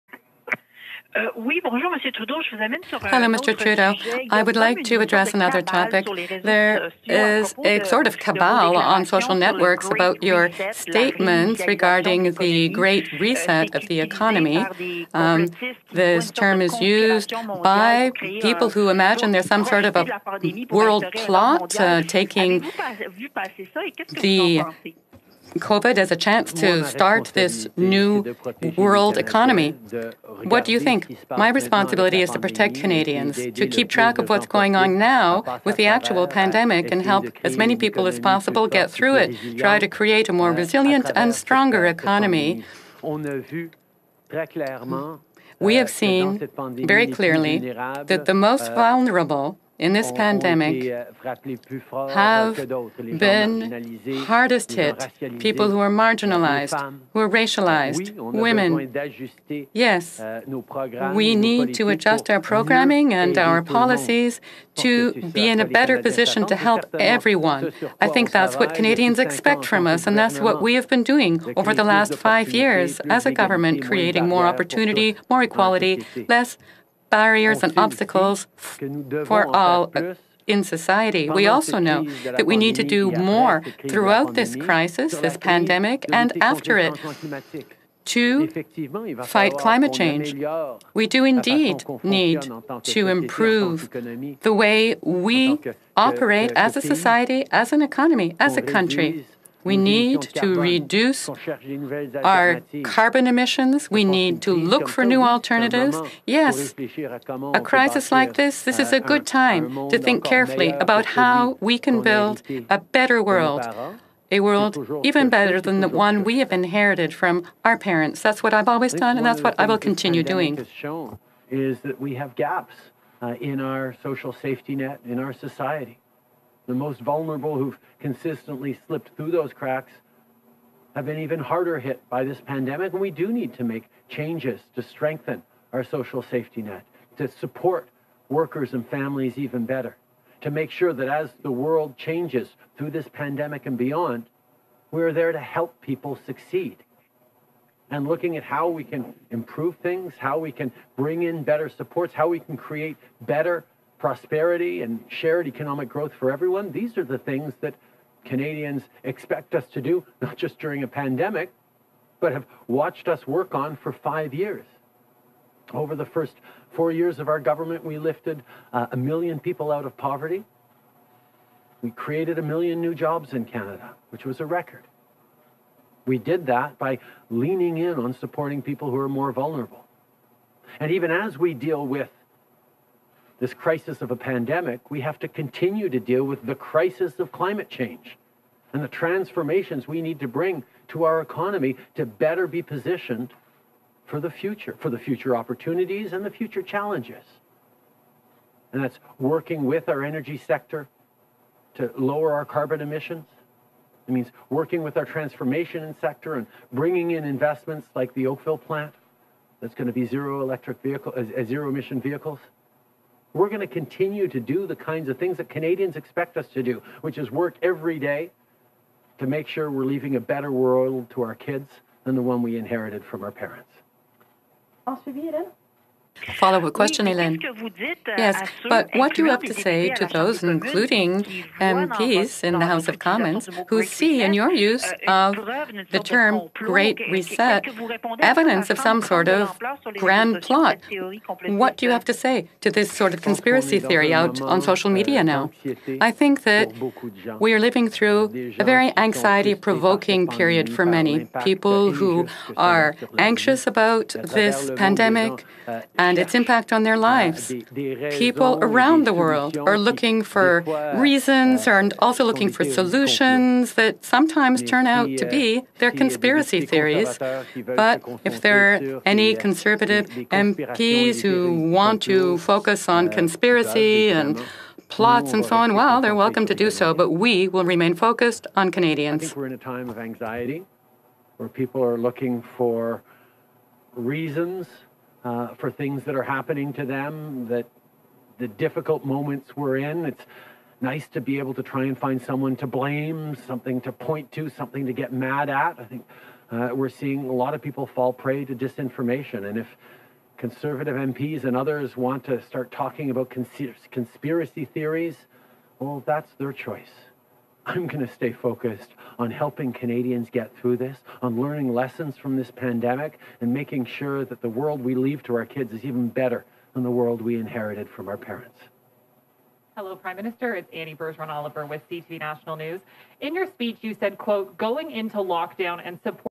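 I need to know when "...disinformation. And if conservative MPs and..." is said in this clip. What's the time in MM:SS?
04:58.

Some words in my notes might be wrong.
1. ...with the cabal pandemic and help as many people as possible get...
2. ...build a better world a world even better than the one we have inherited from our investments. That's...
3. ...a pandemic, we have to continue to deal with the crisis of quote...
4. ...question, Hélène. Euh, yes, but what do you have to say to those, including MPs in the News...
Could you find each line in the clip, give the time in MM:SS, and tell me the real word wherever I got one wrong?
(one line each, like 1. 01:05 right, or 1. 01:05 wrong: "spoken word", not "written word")
1. 00:35 wrong: "actual", not "cabal"
2. 01:52 wrong: "parents", not "investments"
3. 03:04 wrong: "climate", not "quote"
4. 03:46 wrong: "House", not "News".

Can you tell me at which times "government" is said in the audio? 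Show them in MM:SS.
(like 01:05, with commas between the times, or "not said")
01:13, 02:47.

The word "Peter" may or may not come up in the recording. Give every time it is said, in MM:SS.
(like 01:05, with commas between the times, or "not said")
not said.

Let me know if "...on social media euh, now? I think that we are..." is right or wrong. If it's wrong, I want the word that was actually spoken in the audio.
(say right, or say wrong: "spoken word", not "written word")
right.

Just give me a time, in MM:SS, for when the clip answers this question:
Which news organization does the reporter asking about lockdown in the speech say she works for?
05:21.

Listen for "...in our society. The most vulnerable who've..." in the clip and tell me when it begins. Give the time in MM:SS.
02:05.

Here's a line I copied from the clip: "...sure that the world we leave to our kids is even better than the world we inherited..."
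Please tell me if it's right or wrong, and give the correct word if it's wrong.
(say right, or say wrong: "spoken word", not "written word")
right.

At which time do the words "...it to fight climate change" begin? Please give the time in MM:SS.
01:26.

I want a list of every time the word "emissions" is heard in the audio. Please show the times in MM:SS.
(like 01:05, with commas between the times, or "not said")
01:43, 03:22, 03:31.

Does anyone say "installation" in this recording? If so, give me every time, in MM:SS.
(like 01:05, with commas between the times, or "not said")
not said.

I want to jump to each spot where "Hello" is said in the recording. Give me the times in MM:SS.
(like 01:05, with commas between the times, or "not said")
00:01, 05:19.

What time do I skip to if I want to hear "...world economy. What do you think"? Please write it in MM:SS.
00:28.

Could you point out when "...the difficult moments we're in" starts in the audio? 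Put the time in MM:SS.
04:48.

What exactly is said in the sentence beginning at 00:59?
Yes, euh, we need to adjust our programming and our policies to be in a better position to help everyone.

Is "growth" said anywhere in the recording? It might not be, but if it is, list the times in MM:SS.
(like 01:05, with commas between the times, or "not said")
02:35.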